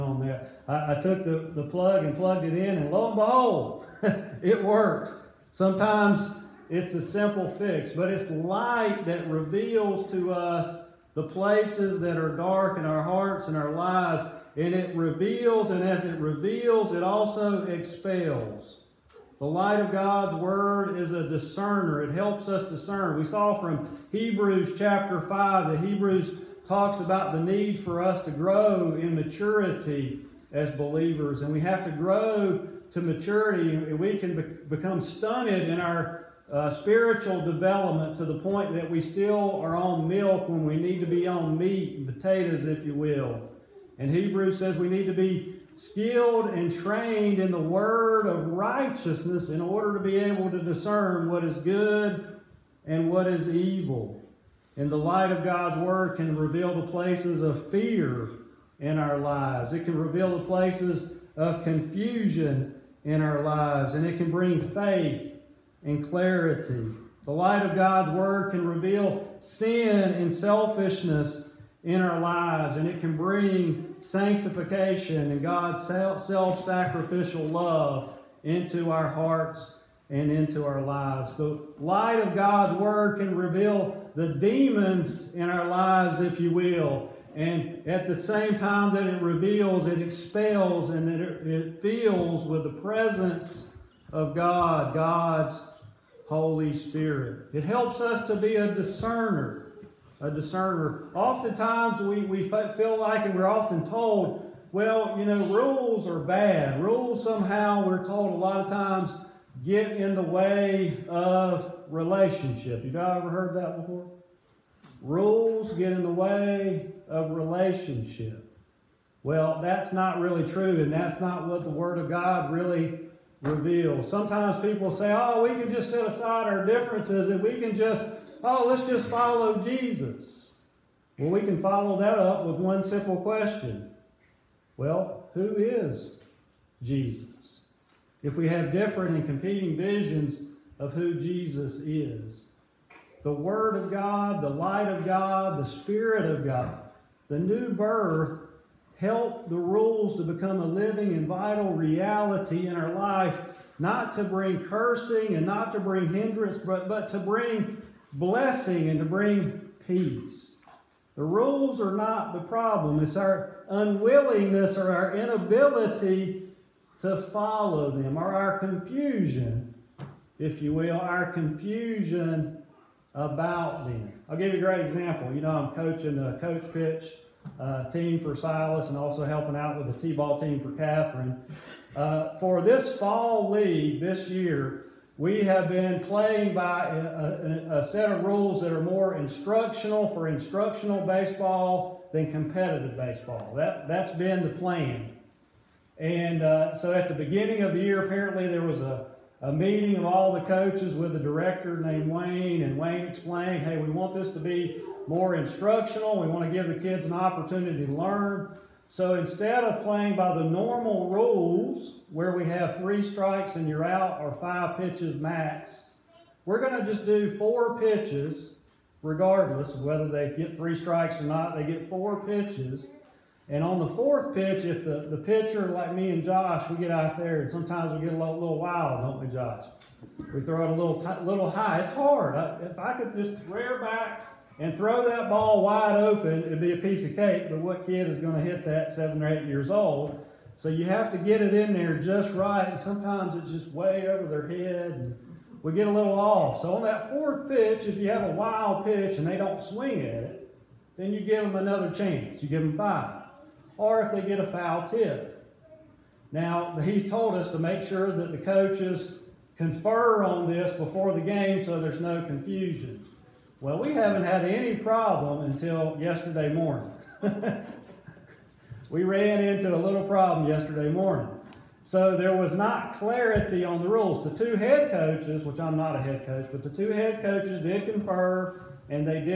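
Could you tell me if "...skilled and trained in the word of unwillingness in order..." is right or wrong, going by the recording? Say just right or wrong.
wrong.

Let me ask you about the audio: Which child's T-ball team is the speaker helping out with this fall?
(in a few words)
Catherine.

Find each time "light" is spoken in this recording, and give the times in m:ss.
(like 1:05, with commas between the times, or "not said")
0:08, 0:19, 0:54, 1:07, 1:21, 2:24.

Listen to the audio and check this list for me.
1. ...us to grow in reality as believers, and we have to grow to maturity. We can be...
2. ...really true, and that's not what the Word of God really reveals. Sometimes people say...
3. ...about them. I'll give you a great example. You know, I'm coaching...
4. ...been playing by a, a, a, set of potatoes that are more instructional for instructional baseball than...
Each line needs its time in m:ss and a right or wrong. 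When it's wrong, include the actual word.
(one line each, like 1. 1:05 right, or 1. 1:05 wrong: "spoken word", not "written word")
1. 0:28 wrong: "maturity", not "reality"
2. 2:00 right
3. 2:53 right
4. 3:05 wrong: "rules", not "potatoes".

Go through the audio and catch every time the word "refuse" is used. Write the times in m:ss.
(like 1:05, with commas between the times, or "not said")
not said.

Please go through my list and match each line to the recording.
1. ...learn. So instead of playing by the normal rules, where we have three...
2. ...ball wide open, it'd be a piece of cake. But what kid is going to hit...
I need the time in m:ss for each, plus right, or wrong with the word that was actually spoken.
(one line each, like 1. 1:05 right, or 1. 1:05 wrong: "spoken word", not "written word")
1. 3:27 right
2. 3:55 right.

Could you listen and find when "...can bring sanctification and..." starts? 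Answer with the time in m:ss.
1:13.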